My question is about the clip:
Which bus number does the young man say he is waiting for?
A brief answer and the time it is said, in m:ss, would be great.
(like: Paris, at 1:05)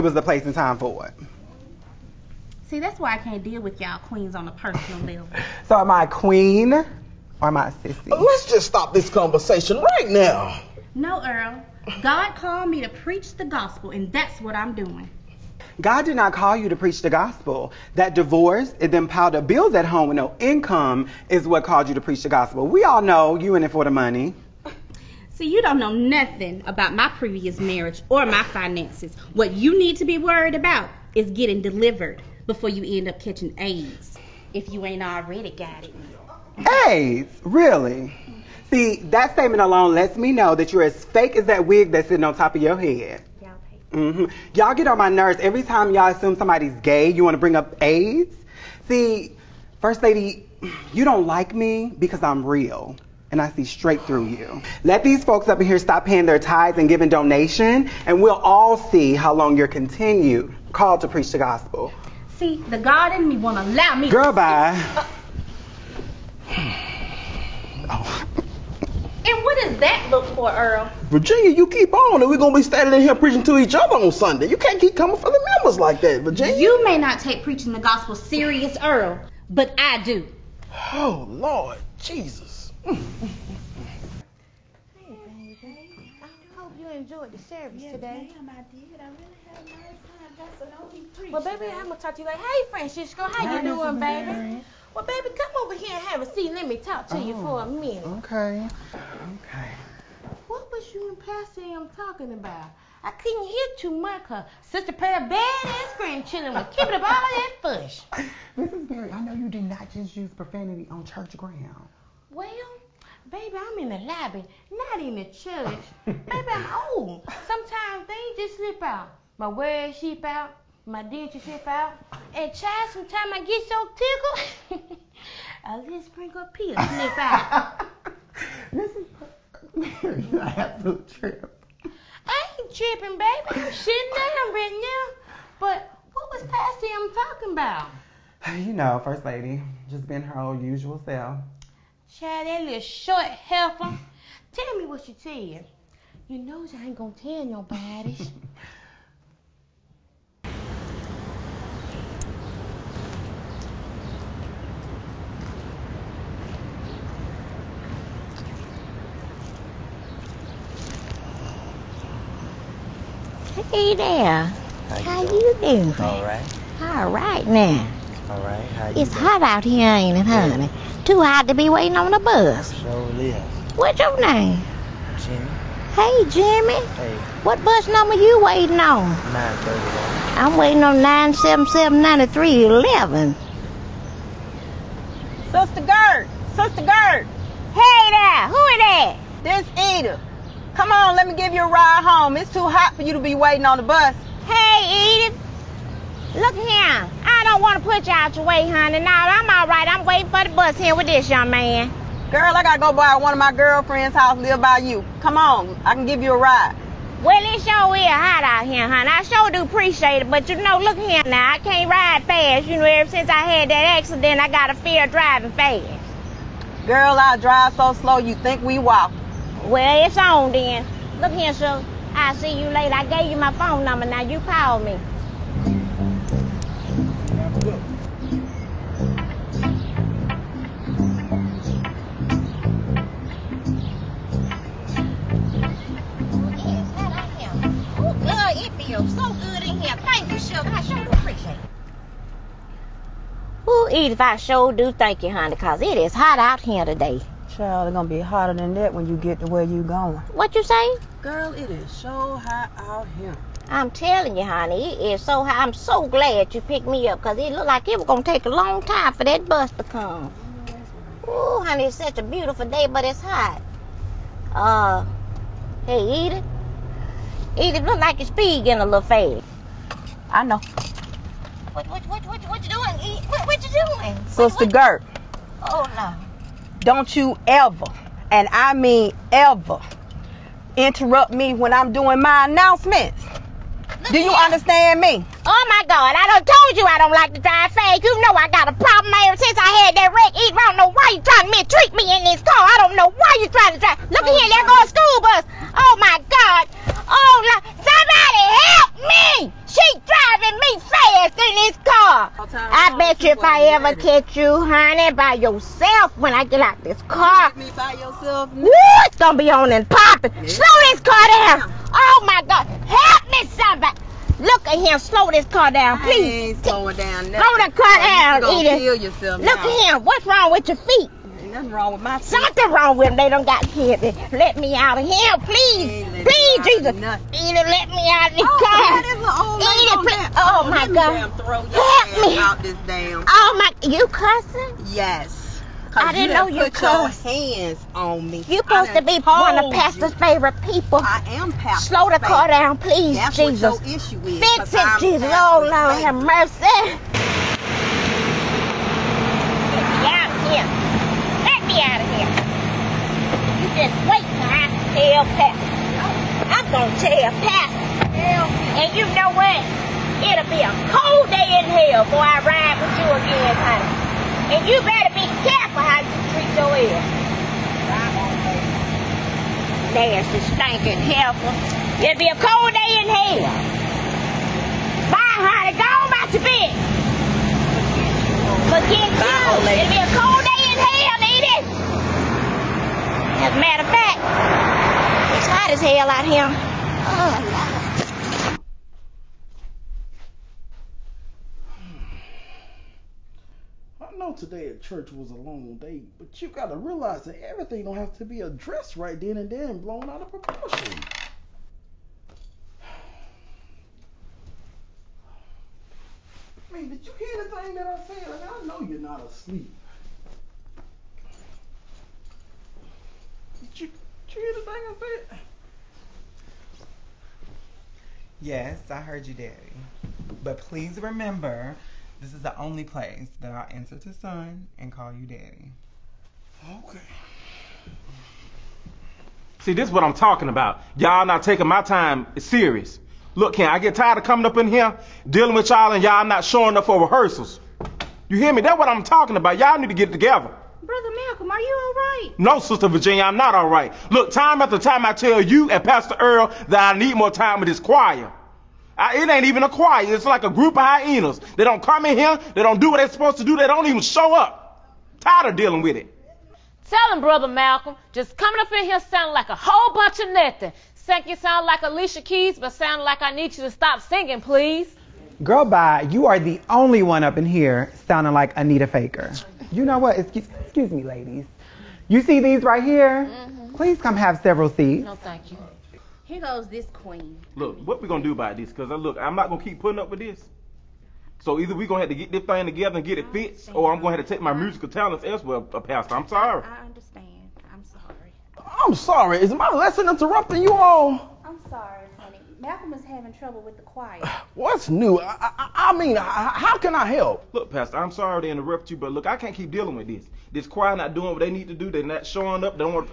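931, at 2:59.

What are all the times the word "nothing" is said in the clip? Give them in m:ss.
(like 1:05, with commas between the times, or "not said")
0:25, 5:21, 7:40.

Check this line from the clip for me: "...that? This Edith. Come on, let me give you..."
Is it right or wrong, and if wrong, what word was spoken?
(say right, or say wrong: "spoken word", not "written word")
right.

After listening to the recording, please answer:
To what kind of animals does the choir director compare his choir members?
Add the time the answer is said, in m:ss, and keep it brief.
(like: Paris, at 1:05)
hyenas, at 7:30.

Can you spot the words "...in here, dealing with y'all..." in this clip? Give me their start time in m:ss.
7:14.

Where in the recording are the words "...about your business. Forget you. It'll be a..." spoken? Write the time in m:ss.
6:16.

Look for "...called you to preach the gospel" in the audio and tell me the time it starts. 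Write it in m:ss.
0:21.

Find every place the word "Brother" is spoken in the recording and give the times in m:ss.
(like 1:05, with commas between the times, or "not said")
7:20, 7:37.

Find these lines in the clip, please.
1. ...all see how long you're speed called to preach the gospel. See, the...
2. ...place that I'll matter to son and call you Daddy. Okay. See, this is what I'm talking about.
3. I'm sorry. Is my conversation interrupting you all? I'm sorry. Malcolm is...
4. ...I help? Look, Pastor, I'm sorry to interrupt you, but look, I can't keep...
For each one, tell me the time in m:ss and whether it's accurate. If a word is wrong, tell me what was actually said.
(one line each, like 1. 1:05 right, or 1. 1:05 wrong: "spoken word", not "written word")
1. 0:58 wrong: "continued", not "speed"
2. 7:02 wrong: "answer", not "matter"
3. 8:08 wrong: "lesson", not "conversation"
4. 8:16 right.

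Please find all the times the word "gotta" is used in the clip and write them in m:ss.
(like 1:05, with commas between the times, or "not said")
3:22, 6:36.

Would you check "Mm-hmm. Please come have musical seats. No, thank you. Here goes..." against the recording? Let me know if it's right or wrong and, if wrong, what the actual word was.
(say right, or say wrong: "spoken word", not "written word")
wrong: "several", not "musical".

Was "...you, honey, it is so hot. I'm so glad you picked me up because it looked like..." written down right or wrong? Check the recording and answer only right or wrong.
right.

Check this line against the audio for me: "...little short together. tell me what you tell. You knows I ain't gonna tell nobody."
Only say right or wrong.
wrong.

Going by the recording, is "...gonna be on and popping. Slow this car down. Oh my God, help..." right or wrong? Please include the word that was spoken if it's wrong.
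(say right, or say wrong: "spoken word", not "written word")
right.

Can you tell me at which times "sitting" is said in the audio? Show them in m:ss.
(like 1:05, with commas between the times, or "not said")
0:42, 2:13.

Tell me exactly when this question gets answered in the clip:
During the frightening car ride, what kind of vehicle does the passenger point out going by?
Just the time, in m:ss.
4:54.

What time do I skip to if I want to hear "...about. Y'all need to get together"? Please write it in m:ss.
7:19.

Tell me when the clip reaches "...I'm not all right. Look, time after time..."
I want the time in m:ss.
7:23.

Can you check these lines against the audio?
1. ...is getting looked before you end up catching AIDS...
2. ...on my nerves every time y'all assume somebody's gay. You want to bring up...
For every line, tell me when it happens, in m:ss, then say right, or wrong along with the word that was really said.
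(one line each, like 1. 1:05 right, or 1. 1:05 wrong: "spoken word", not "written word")
1. 0:31 wrong: "delivered", not "looked"
2. 0:44 right.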